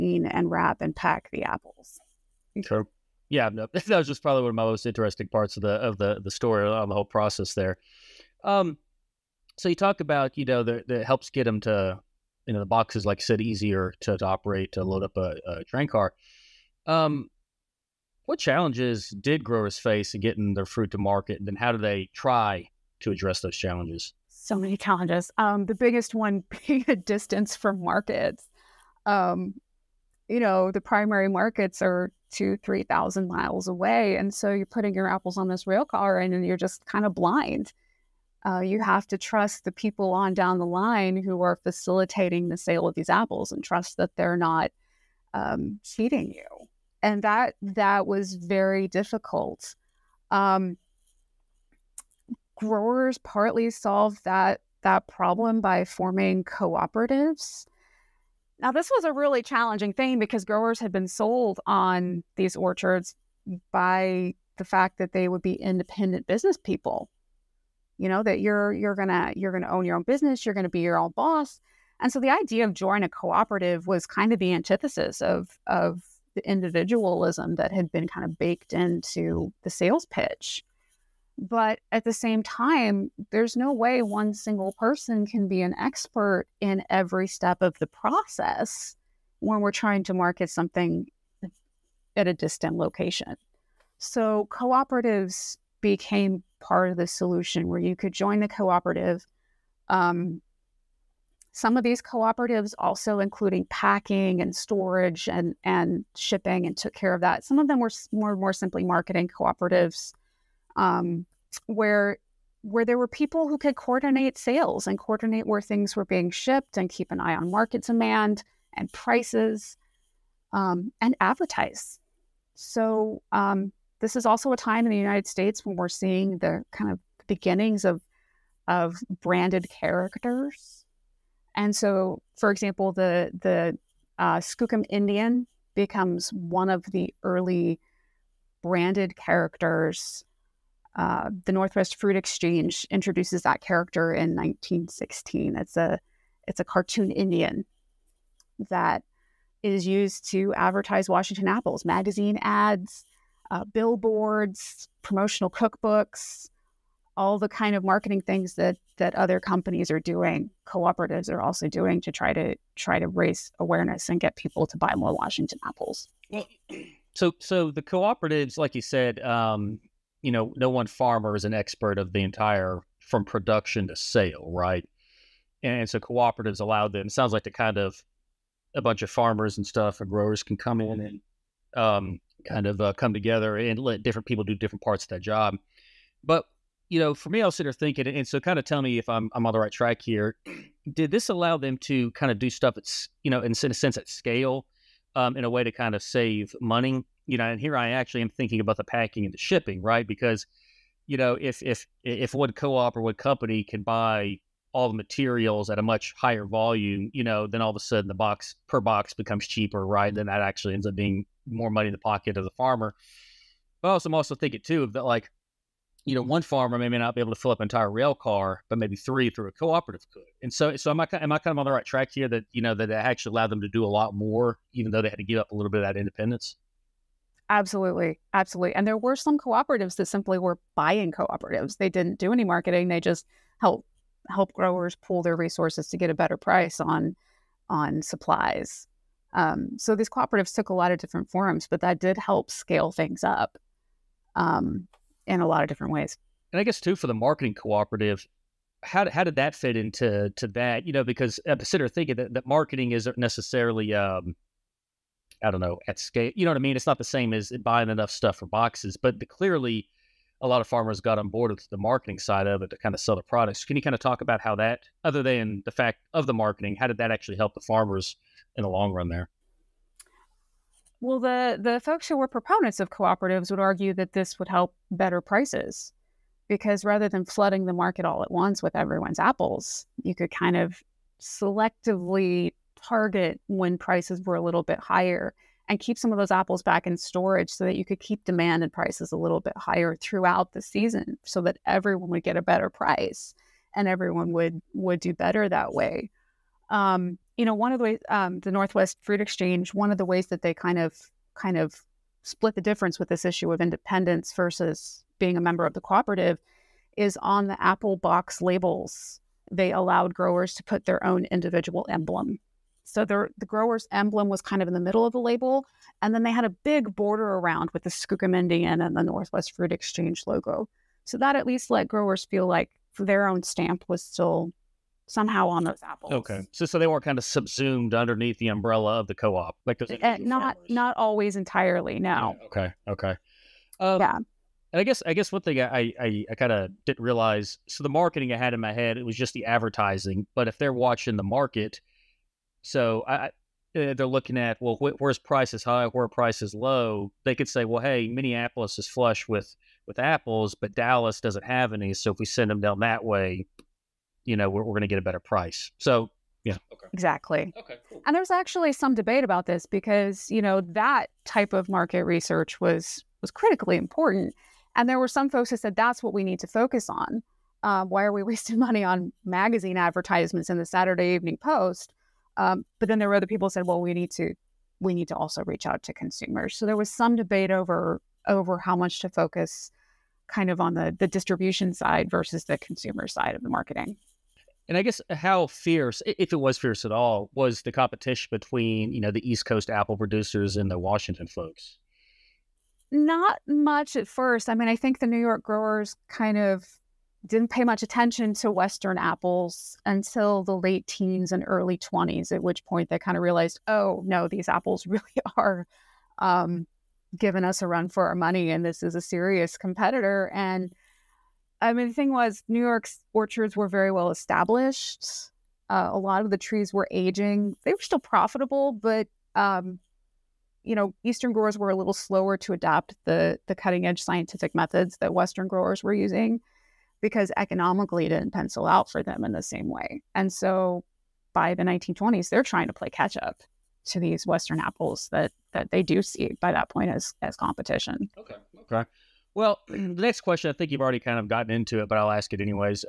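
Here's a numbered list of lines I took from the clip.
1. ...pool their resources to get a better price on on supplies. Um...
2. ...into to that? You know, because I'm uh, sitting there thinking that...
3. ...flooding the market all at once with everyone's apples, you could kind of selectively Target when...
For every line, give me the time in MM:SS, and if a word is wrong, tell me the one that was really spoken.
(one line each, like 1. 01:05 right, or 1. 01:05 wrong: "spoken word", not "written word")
1. 03:54 right
2. 04:09 right
3. 04:37 right.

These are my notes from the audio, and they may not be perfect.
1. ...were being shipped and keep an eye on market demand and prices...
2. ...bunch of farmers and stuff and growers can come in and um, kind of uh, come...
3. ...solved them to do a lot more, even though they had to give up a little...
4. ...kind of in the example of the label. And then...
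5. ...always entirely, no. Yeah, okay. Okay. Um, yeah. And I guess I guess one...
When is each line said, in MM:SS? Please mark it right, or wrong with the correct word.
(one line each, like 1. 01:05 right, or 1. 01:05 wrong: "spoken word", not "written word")
1. 01:55 right
2. 02:58 right
3. 03:43 wrong: "allowed", not "solved"
4. 05:14 wrong: "middle", not "example"
5. 05:30 right.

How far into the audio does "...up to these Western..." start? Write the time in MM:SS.
07:13.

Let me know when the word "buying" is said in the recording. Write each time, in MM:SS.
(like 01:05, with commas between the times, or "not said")
03:50, 04:17.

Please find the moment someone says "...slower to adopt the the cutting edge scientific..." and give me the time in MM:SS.
07:01.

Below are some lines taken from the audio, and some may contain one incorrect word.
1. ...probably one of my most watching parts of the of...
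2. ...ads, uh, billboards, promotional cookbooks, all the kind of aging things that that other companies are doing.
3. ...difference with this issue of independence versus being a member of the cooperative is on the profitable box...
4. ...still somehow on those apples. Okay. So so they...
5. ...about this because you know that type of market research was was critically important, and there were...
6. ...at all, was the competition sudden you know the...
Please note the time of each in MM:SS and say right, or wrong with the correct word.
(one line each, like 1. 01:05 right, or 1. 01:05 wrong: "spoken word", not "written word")
1. 00:04 wrong: "interesting", not "watching"
2. 02:32 wrong: "marketing", not "aging"
3. 05:02 wrong: "apple", not "profitable"
4. 05:24 right
5. 05:59 right
6. 06:26 wrong: "between", not "sudden".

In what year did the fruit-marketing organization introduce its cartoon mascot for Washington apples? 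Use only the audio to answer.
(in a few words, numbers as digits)
1916.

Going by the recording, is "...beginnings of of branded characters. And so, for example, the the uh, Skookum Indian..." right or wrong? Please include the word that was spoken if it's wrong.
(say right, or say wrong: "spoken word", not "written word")
right.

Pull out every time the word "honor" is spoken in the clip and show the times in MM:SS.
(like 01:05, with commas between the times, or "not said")
not said.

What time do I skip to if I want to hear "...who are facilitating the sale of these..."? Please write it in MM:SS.
00:41.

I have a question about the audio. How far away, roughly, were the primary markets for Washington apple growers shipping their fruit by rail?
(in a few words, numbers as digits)
2,000 to 3,000 miles.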